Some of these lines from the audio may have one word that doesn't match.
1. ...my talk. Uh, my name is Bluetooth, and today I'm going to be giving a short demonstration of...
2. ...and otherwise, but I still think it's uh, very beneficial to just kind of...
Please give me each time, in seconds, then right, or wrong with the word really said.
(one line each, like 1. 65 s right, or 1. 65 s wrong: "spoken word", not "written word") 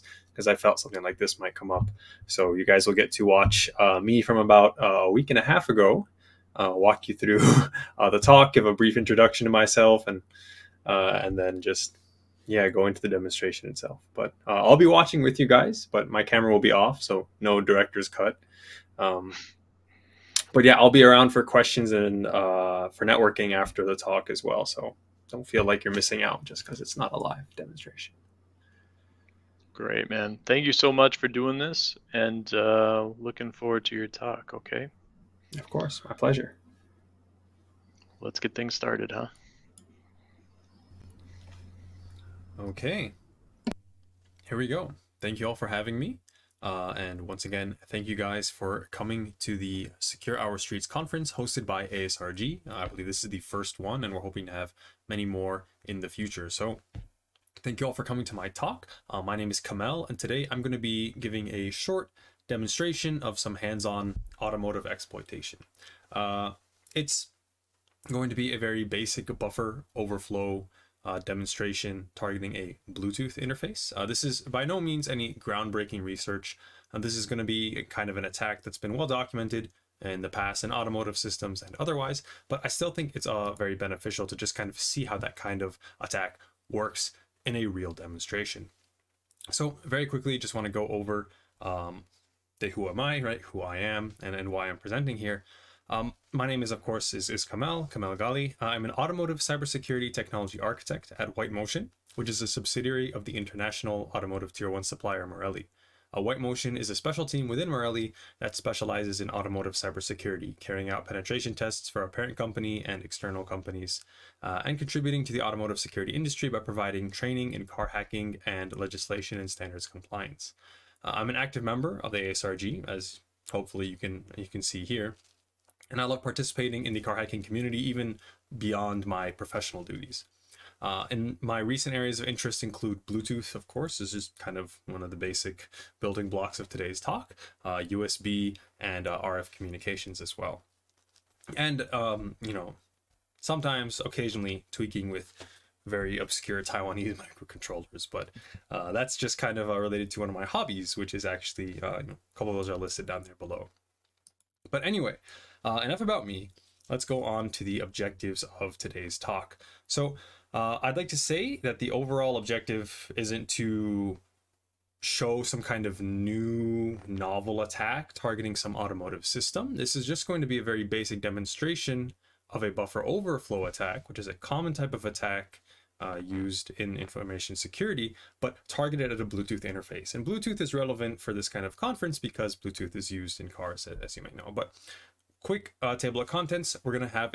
1. 58 s wrong: "Kamel", not "Bluetooth"
2. 81 s right.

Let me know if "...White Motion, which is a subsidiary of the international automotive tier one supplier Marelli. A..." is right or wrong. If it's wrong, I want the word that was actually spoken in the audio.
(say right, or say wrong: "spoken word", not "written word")
right.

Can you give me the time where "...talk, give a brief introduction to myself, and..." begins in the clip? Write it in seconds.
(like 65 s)
8 s.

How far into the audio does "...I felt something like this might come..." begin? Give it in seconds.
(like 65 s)
0 s.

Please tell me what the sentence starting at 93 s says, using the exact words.
Who I am and, and why I'm presenting here.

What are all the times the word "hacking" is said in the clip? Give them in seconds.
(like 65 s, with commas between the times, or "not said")
117 s, 127 s.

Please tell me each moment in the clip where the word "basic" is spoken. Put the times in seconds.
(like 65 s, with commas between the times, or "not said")
68 s, 135 s, 170 s.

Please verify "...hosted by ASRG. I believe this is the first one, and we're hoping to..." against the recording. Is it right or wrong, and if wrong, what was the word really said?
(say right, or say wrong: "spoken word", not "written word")
right.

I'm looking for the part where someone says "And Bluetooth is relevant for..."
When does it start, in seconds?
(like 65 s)
180 s.